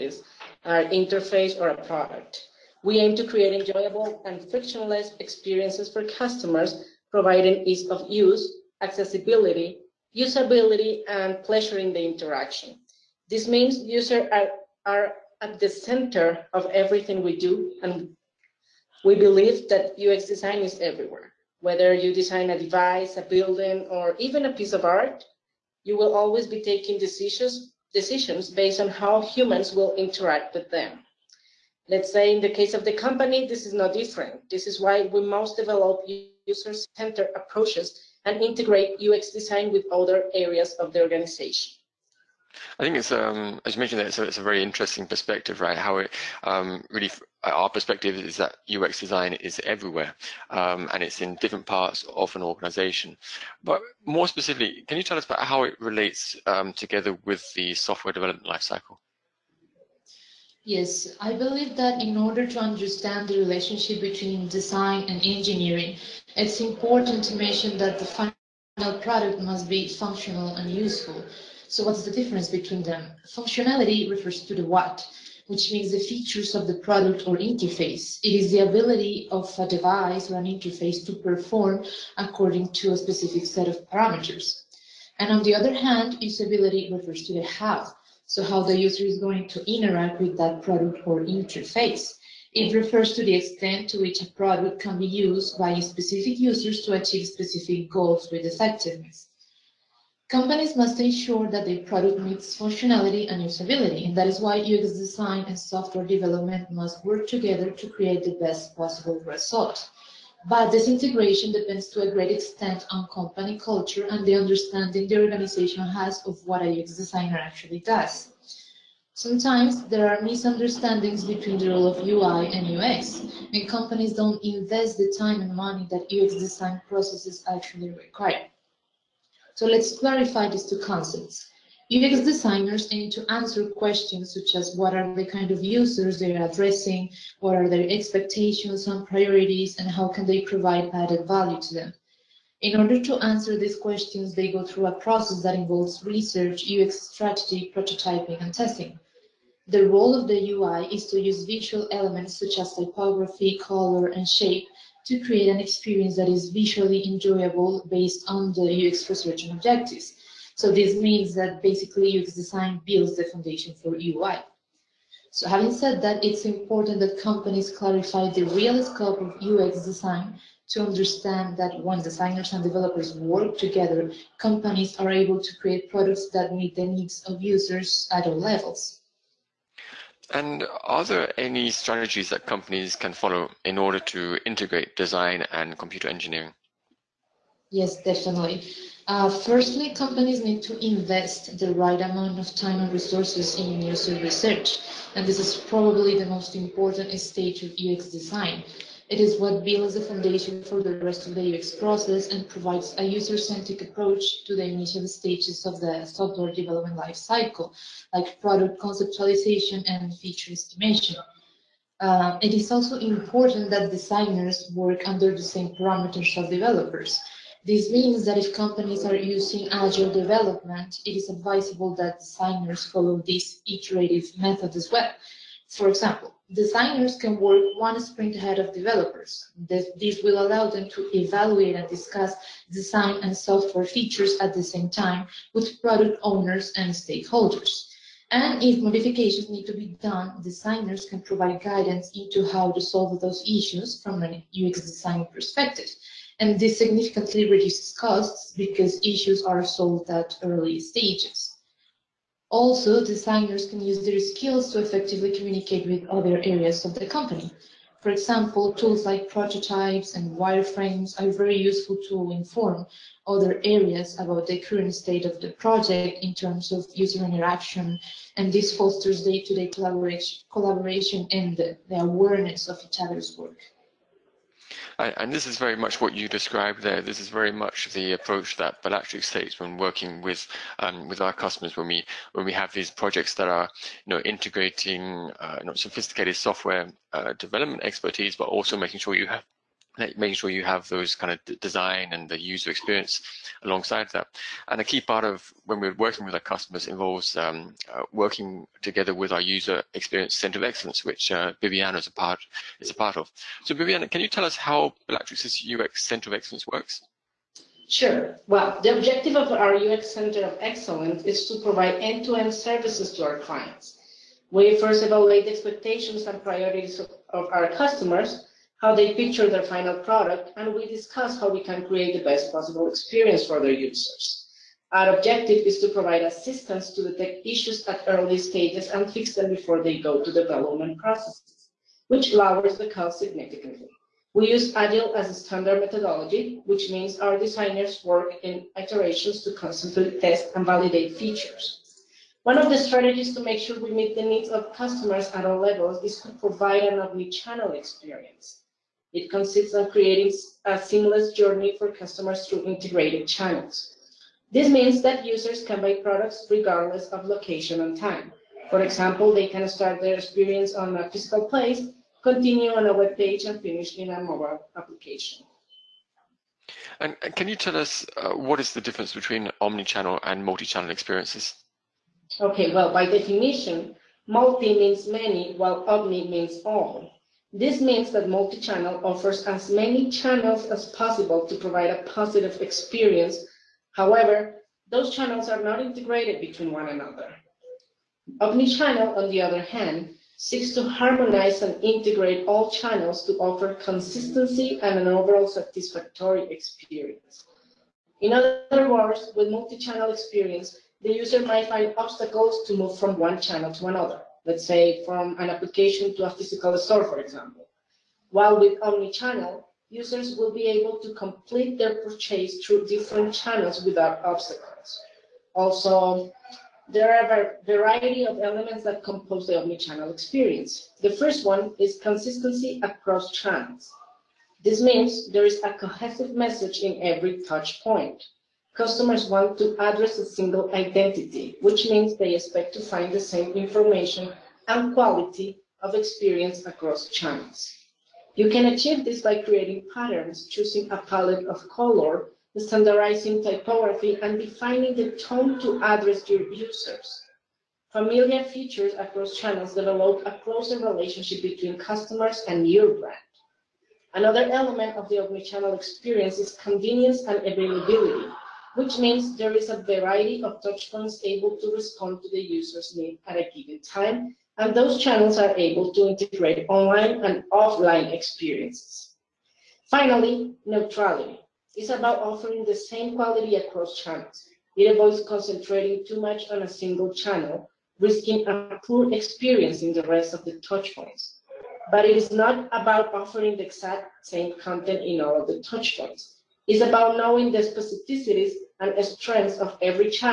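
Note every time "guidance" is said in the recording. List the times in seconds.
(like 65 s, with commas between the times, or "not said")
241 s.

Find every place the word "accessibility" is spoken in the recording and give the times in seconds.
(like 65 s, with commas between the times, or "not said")
8 s.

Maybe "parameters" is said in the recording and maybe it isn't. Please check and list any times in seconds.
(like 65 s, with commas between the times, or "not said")
83 s, 215 s.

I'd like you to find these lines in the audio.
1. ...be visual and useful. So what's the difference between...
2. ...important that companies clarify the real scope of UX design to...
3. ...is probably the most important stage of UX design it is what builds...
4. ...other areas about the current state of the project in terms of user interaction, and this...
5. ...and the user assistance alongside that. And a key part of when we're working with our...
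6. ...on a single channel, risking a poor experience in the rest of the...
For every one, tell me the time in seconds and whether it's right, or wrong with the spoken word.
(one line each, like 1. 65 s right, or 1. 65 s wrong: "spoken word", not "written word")
1. 69 s wrong: "functional", not "visual"
2. 166 s right
3. 195 s right
4. 263 s right
5. 292 s wrong: "experience", not "assistance"
6. 476 s right.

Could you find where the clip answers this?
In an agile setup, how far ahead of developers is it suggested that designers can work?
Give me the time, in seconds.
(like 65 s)
227 s.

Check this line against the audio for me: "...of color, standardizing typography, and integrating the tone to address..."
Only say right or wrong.
wrong.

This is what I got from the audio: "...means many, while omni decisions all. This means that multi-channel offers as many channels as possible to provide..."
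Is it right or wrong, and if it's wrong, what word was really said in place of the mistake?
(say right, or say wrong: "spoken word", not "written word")
wrong: "means", not "decisions".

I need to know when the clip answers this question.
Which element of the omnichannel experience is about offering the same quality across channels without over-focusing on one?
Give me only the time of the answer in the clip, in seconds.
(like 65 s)
470 s.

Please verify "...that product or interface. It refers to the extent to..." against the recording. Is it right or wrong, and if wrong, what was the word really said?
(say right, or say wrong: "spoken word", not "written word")
right.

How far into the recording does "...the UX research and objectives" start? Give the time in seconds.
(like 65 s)
158 s.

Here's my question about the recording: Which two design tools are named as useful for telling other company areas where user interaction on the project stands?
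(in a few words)
prototypes and wireframes.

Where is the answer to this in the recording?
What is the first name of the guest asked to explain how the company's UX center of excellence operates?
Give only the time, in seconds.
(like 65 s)
303 s.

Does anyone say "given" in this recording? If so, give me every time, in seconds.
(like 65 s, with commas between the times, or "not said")
463 s.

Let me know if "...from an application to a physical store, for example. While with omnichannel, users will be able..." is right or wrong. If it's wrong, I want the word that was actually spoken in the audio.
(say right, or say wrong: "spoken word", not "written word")
right.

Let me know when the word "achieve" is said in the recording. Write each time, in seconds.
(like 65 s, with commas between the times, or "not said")
96 s, 438 s.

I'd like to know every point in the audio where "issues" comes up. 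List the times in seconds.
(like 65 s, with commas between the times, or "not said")
243 s, 249 s, 327 s.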